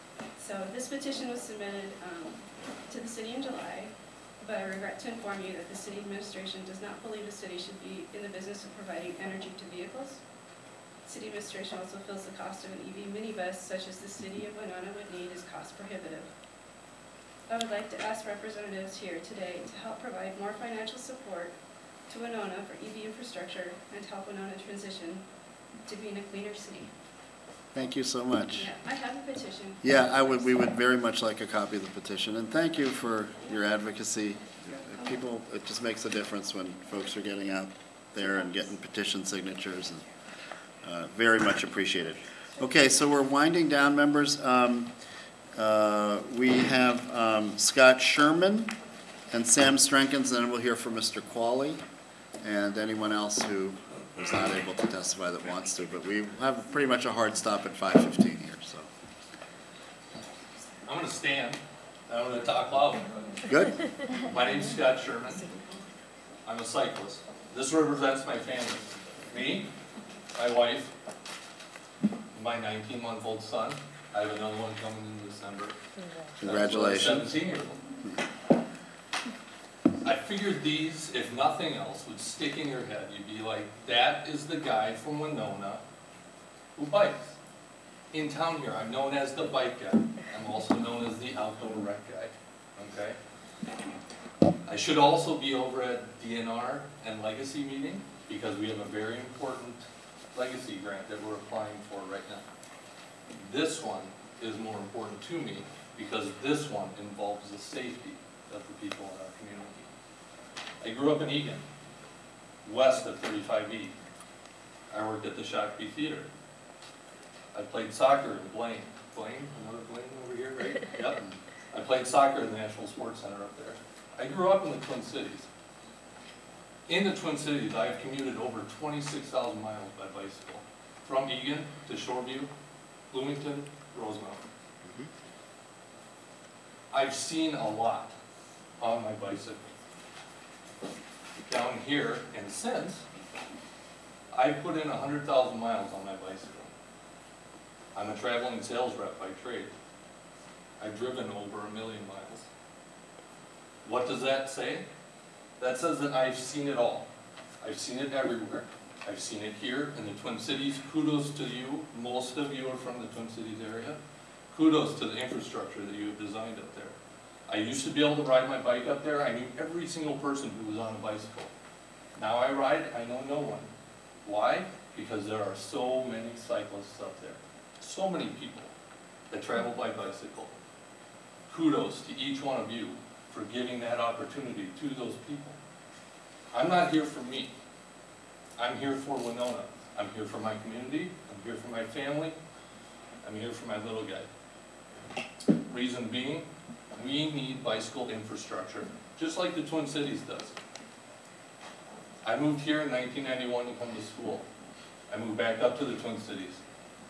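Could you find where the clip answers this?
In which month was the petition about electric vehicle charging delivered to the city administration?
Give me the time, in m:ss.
0:03.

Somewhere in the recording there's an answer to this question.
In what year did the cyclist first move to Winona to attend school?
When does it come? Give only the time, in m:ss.
3:22.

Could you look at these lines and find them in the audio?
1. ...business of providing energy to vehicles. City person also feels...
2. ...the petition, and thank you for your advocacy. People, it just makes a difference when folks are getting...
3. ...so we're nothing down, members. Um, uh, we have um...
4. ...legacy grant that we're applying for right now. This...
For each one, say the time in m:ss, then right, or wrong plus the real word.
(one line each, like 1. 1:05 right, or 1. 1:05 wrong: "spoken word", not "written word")
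1. 0:08 wrong: "administration", not "person"
2. 0:31 right
3. 0:42 wrong: "winding", not "nothing"
4. 1:40 right.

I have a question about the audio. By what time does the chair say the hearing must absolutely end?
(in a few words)
5:15.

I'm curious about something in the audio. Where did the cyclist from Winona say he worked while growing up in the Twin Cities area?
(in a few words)
Shakopee Theater.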